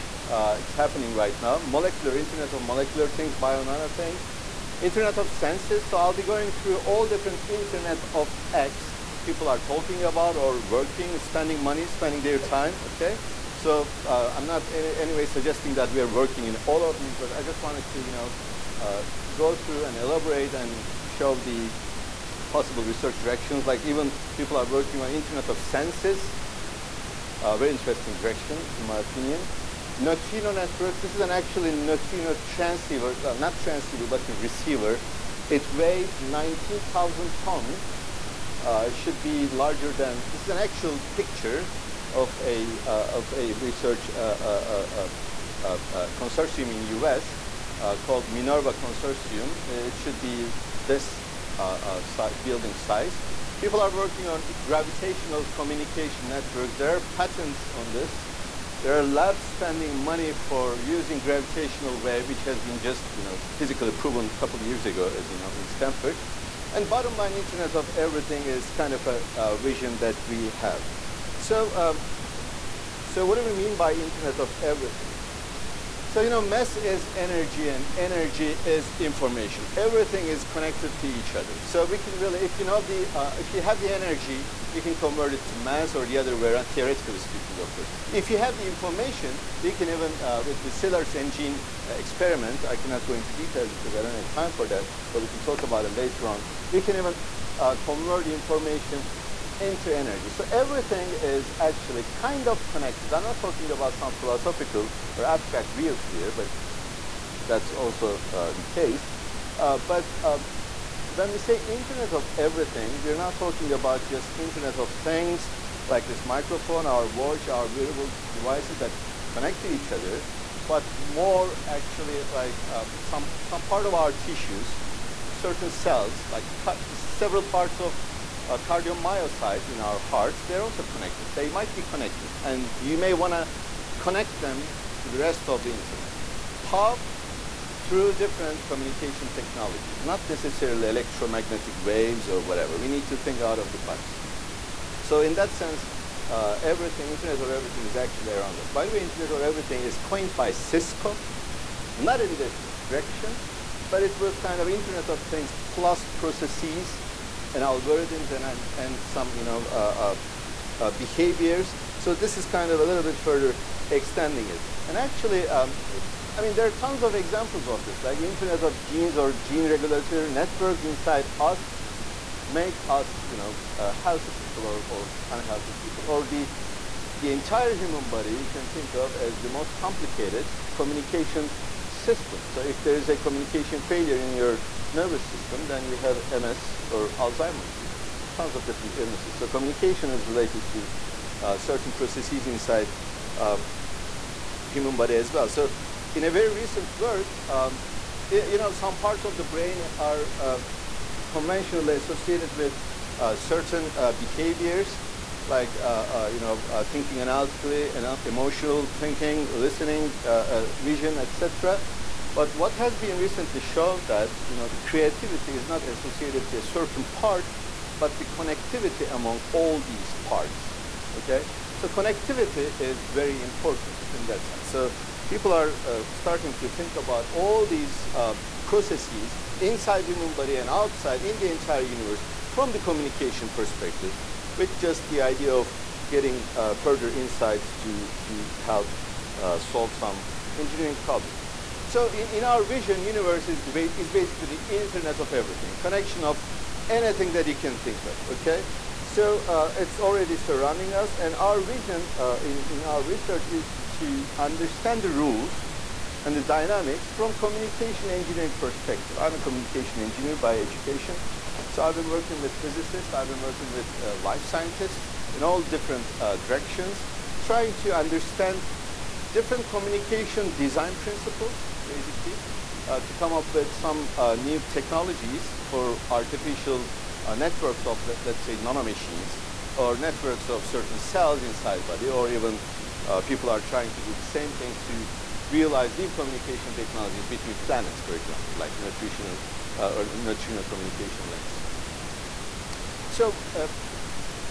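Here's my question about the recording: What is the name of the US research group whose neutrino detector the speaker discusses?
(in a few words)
Minerva Consortium.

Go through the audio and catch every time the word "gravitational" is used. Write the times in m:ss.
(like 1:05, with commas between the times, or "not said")
0:54, 1:01.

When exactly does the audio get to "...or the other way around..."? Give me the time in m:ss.
1:25.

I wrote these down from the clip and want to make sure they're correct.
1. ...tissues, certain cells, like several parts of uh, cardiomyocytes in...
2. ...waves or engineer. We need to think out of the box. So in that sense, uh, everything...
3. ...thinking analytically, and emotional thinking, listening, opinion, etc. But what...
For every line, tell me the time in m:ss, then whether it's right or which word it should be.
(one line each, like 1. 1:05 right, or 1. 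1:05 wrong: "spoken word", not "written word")
1. 2:04 right
2. 2:21 wrong: "whatever", not "engineer"
3. 3:26 wrong: "vision", not "opinion".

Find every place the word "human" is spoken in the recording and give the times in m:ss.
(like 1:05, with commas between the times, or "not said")
2:57, 3:14, 3:50.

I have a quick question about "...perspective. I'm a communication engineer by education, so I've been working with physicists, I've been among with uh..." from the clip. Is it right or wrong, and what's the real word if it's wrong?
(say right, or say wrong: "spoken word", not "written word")
wrong: "working", not "among".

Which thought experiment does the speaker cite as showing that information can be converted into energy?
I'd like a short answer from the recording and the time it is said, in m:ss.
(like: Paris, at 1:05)
Szilard's engine, at 1:30.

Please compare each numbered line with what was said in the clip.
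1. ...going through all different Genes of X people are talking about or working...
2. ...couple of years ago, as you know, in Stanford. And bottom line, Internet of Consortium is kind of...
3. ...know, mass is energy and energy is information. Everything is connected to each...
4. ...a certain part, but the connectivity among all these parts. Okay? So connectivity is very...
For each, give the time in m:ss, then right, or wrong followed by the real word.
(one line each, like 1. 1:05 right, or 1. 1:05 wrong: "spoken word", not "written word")
1. 0:06 wrong: "Internet", not "Genes"
2. 1:04 wrong: "Everything", not "Consortium"
3. 1:16 right
4. 3:36 right.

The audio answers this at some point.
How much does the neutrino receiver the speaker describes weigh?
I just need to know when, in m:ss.
0:36.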